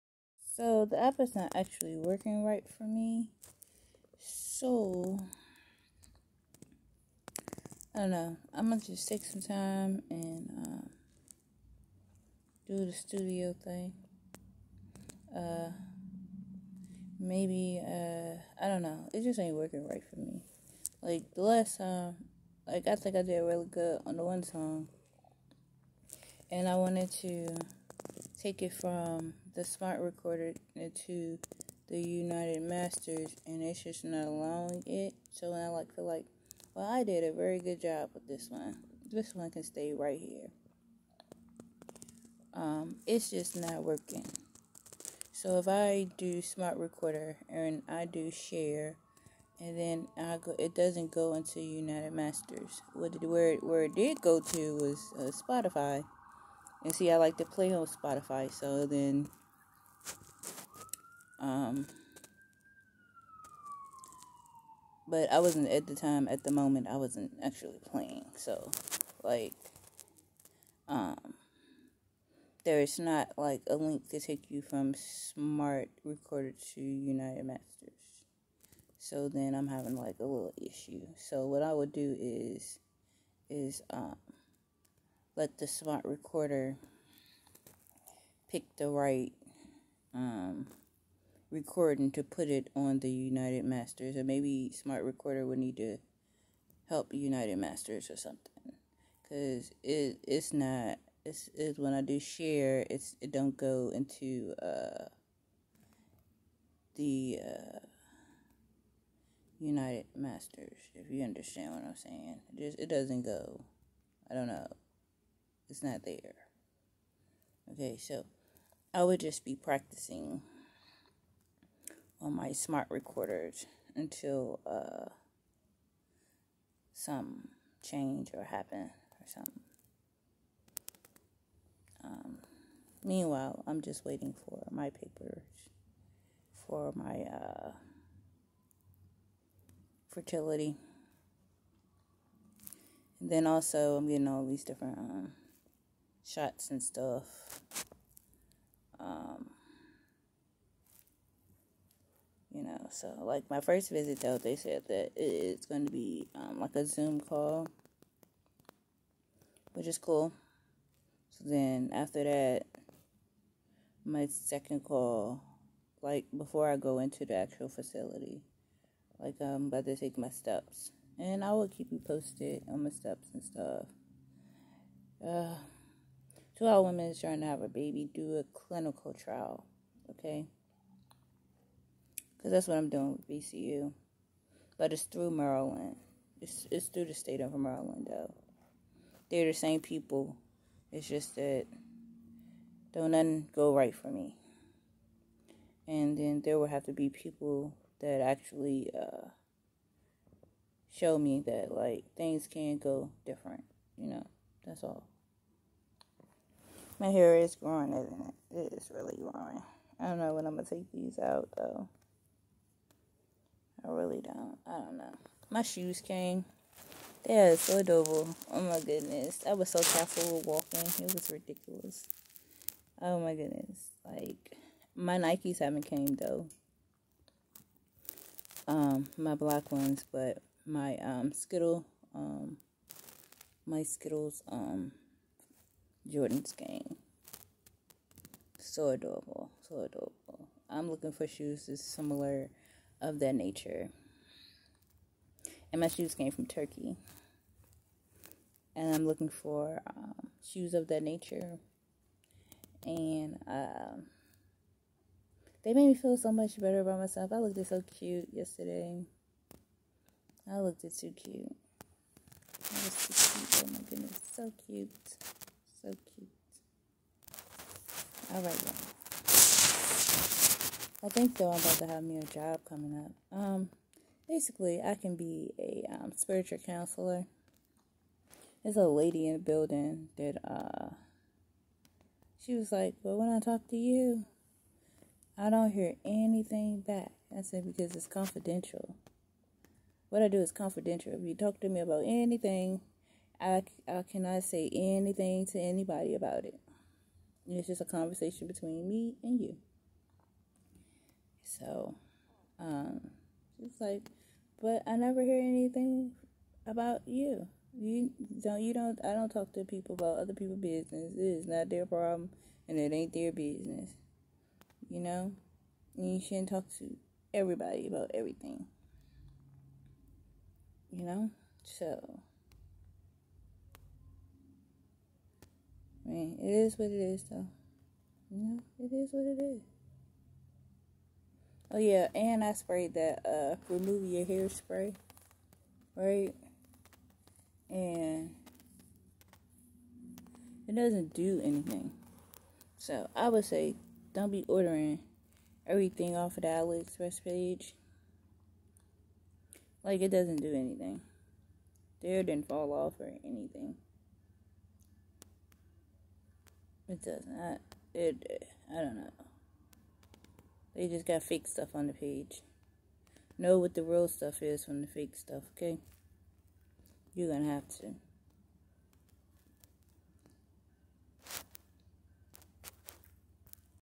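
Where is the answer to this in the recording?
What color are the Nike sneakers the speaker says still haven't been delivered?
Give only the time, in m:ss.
3:49.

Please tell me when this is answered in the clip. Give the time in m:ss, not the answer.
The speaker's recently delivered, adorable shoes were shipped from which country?
4:06.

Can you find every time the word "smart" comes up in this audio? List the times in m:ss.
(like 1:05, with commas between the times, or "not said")
0:29, 0:46, 1:14, 1:25, 1:34, 2:02.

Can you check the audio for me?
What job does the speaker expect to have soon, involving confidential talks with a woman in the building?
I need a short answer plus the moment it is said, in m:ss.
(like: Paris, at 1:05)
Spiritual counselor, at 4:36.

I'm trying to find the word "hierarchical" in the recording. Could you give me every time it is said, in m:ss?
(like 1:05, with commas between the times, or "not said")
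not said.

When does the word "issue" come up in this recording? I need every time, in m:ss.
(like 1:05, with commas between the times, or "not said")
1:20.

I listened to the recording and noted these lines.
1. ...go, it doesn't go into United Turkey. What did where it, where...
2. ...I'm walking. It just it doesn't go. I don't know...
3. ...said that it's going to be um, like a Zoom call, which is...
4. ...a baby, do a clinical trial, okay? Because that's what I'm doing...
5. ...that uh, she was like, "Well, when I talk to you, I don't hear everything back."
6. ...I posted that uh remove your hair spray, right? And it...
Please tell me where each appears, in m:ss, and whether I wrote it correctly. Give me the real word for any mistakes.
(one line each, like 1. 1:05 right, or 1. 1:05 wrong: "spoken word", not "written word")
1. 0:50 wrong: "Masters", not "Turkey"
2. 1:51 wrong: "saying", not "walking"
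3. 2:34 right
4. 2:57 right
5. 4:40 wrong: "anything", not "everything"
6. 5:32 wrong: "sprayed", not "posted".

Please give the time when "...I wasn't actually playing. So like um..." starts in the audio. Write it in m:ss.
1:06.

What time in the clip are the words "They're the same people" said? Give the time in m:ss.
3:09.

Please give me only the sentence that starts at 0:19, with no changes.
It just ain't working right for me.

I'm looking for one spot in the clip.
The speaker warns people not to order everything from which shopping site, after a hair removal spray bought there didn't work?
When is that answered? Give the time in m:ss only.
5:46.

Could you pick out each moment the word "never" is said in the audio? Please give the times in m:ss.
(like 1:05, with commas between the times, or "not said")
5:04.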